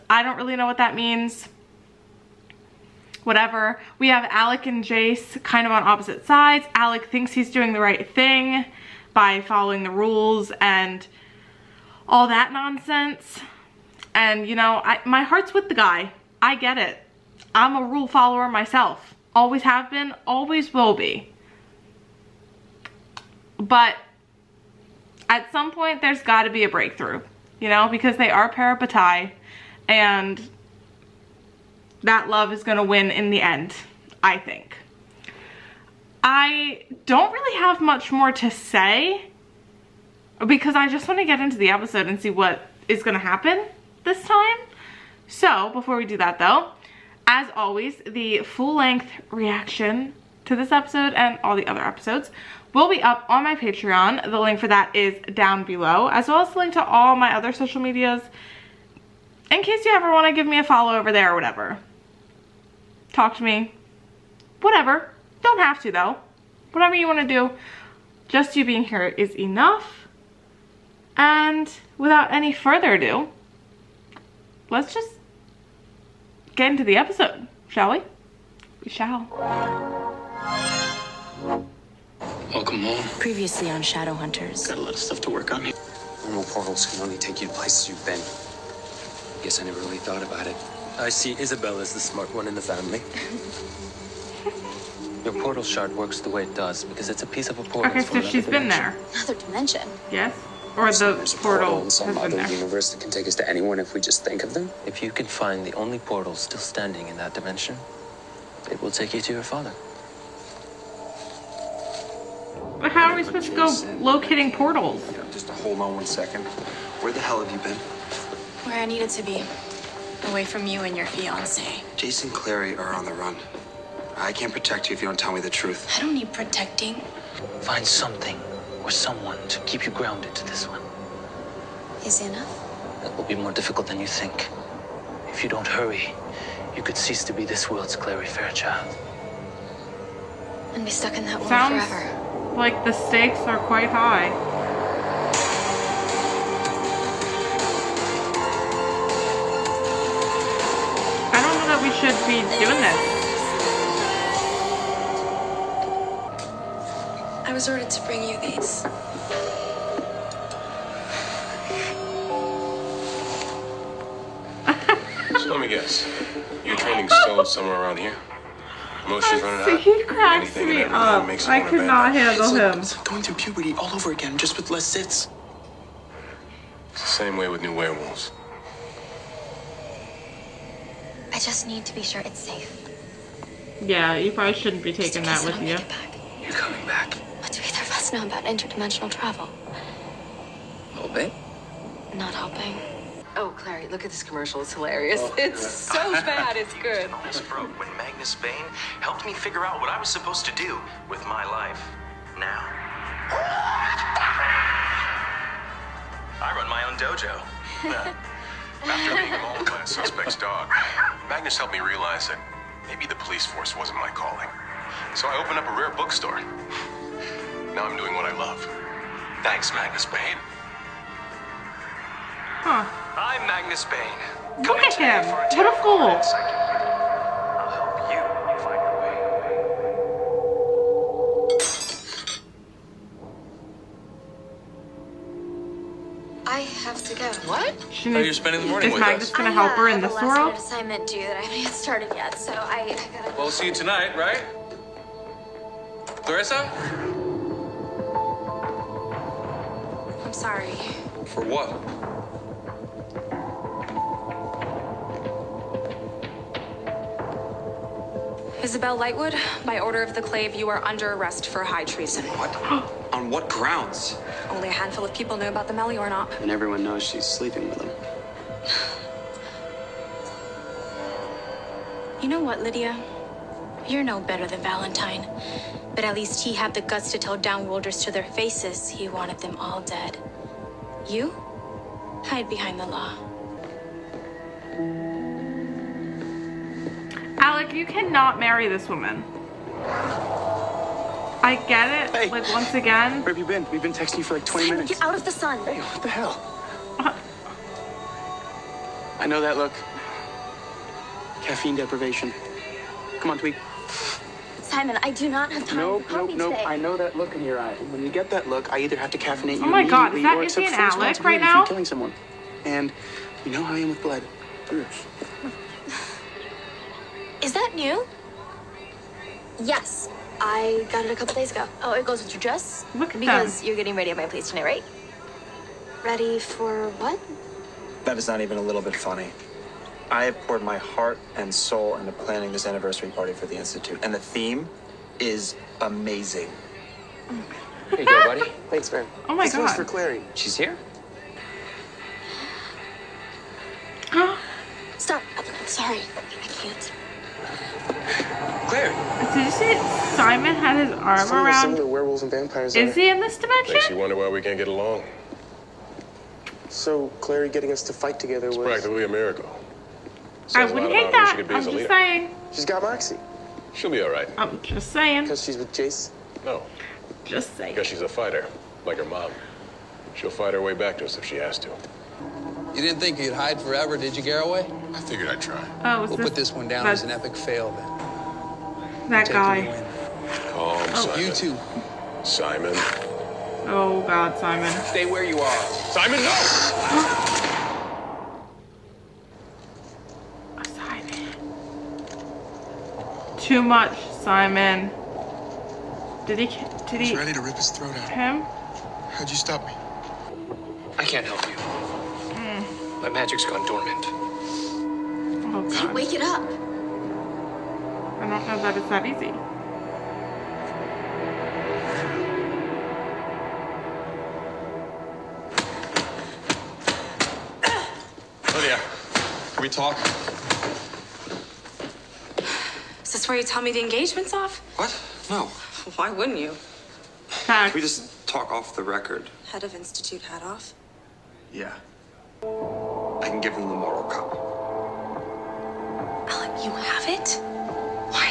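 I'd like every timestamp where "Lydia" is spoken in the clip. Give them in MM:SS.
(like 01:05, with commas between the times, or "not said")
04:32, 06:58.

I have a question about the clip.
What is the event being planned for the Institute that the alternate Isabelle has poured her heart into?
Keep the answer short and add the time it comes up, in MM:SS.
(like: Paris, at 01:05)
anniversary party, at 05:32.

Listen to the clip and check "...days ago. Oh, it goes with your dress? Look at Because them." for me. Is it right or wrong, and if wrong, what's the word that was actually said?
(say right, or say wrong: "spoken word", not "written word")
right.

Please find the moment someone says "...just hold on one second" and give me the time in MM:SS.
01:55.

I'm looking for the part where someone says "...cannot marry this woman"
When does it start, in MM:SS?
04:47.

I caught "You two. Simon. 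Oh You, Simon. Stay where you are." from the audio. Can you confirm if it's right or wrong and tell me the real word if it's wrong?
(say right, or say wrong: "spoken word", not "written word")
wrong: "God", not "You".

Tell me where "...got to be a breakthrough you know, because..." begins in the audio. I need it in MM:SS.
00:26.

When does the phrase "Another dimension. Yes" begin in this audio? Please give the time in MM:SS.
01:39.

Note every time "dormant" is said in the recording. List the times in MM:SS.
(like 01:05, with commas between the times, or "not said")
06:43.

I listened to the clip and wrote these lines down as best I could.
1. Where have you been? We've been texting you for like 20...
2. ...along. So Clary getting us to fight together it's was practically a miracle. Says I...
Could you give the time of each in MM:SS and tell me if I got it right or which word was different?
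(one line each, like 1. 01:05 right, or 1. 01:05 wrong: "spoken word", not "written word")
1. 04:53 right
2. 05:54 right.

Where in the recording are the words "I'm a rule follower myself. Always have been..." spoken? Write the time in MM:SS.
00:17.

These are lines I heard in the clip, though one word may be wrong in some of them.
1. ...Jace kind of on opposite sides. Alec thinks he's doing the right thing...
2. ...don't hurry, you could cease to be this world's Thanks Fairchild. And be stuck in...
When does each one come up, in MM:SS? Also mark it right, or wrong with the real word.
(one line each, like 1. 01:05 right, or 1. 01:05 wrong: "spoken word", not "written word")
1. 00:04 right
2. 02:15 wrong: "Clary", not "Thanks".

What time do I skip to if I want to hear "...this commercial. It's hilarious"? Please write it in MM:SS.
03:14.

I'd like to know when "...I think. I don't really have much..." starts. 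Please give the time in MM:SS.
00:34.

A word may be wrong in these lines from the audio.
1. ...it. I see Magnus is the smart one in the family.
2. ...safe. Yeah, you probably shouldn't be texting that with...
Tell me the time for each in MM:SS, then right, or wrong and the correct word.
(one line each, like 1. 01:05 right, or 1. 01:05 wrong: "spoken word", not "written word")
1. 01:30 wrong: "Isabelle", not "Magnus"
2. 03:02 wrong: "taking", not "texting".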